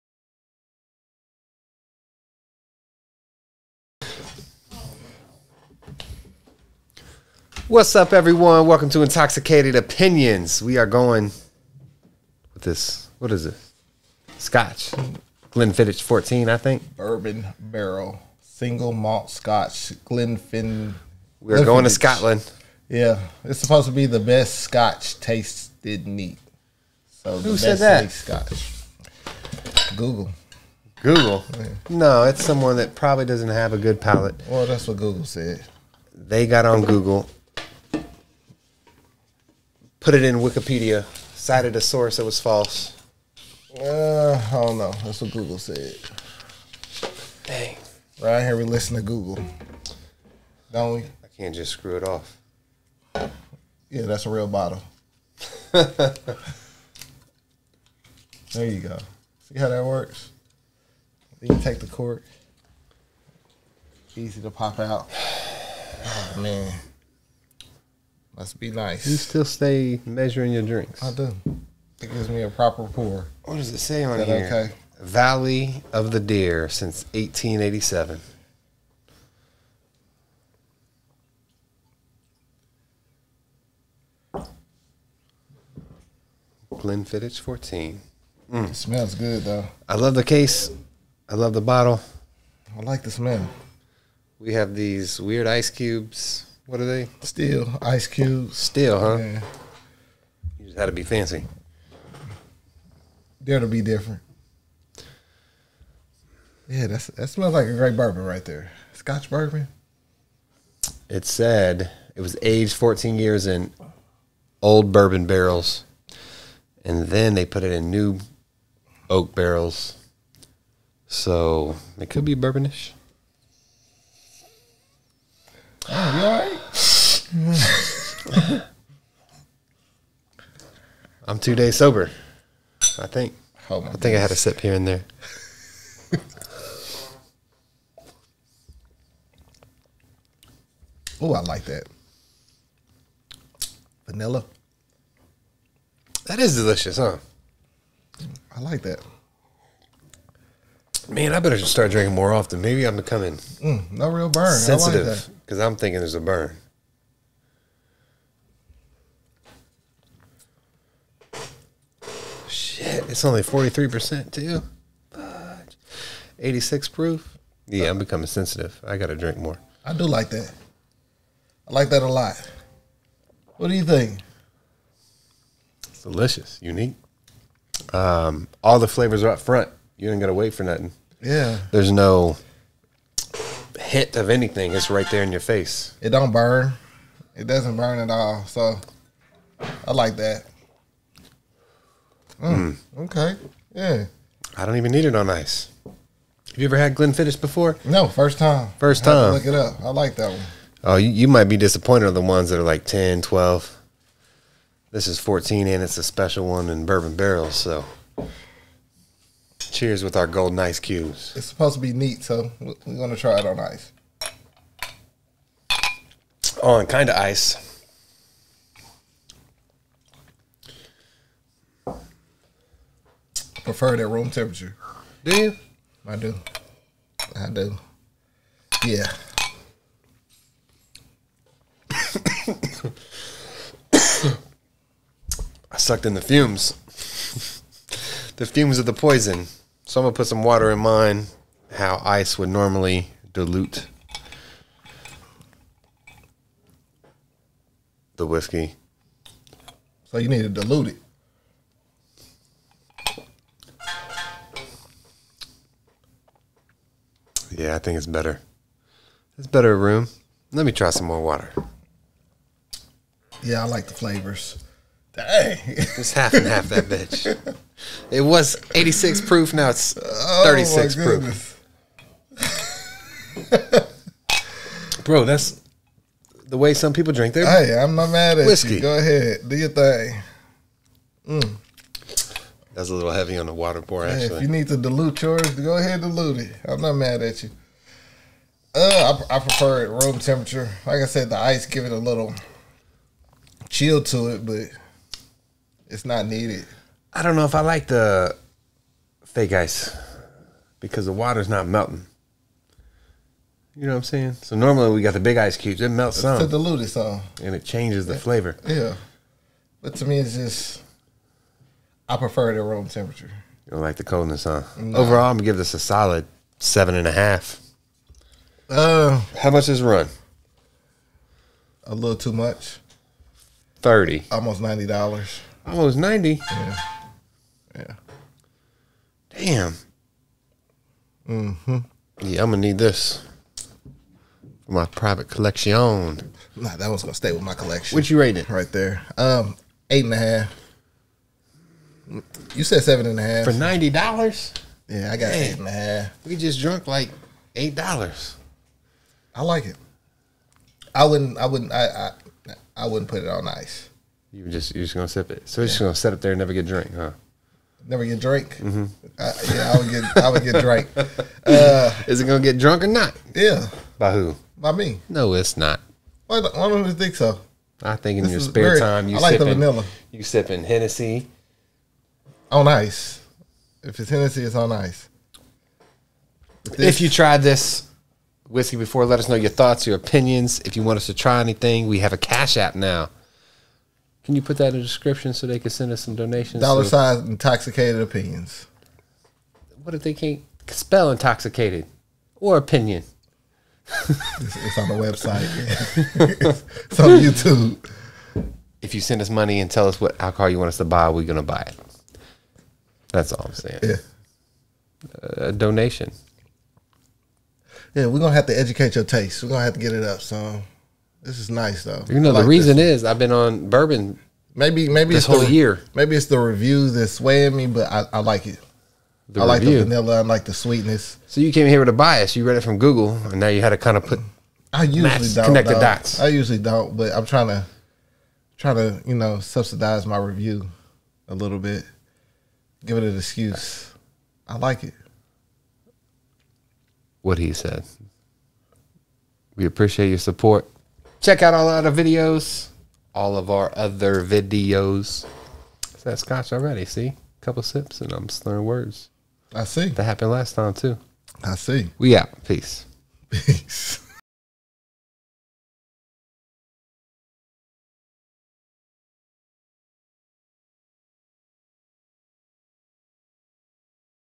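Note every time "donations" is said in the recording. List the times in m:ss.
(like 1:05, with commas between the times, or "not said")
6:26, 6:45.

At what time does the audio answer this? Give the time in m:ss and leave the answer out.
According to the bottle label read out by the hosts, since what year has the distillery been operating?
1:17.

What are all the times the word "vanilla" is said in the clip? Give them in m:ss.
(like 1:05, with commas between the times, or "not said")
2:24, 6:09, 6:59.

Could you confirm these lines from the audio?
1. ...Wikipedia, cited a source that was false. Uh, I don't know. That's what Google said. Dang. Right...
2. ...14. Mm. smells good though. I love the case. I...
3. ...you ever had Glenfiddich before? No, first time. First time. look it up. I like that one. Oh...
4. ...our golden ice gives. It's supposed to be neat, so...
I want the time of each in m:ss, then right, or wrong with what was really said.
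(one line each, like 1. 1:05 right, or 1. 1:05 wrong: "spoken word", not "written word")
1. 0:40 right
2. 1:27 right
3. 3:16 right
4. 3:30 wrong: "cubes", not "gives".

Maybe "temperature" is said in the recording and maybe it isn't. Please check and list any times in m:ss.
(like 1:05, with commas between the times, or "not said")
3:44, 4:50, 5:12.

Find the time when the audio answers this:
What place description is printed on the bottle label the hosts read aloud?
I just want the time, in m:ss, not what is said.
1:14.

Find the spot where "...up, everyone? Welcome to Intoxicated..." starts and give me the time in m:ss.
0:07.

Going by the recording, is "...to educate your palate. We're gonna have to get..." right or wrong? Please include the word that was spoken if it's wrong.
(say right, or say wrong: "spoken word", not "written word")
wrong: "taste", not "palate".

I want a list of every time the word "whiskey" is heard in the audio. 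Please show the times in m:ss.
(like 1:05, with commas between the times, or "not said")
4:08, 4:38, 6:18.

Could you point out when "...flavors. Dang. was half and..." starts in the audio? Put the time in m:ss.
4:23.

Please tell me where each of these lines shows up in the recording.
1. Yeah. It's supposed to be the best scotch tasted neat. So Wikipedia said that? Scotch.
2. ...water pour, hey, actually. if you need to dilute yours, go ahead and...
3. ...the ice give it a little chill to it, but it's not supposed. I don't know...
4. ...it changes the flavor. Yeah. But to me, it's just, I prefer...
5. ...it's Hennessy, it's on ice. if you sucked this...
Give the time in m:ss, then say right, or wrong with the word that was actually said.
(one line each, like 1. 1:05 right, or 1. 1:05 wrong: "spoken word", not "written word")
1. 0:22 wrong: "Who", not "Wikipedia"
2. 4:43 right
3. 4:51 wrong: "needed", not "supposed"
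4. 5:07 right
5. 6:13 wrong: "tried", not "sucked".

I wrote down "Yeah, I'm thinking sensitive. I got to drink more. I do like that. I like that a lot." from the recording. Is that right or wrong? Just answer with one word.
wrong.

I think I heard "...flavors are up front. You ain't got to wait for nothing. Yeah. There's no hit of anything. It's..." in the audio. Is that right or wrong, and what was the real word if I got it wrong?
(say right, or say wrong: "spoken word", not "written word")
right.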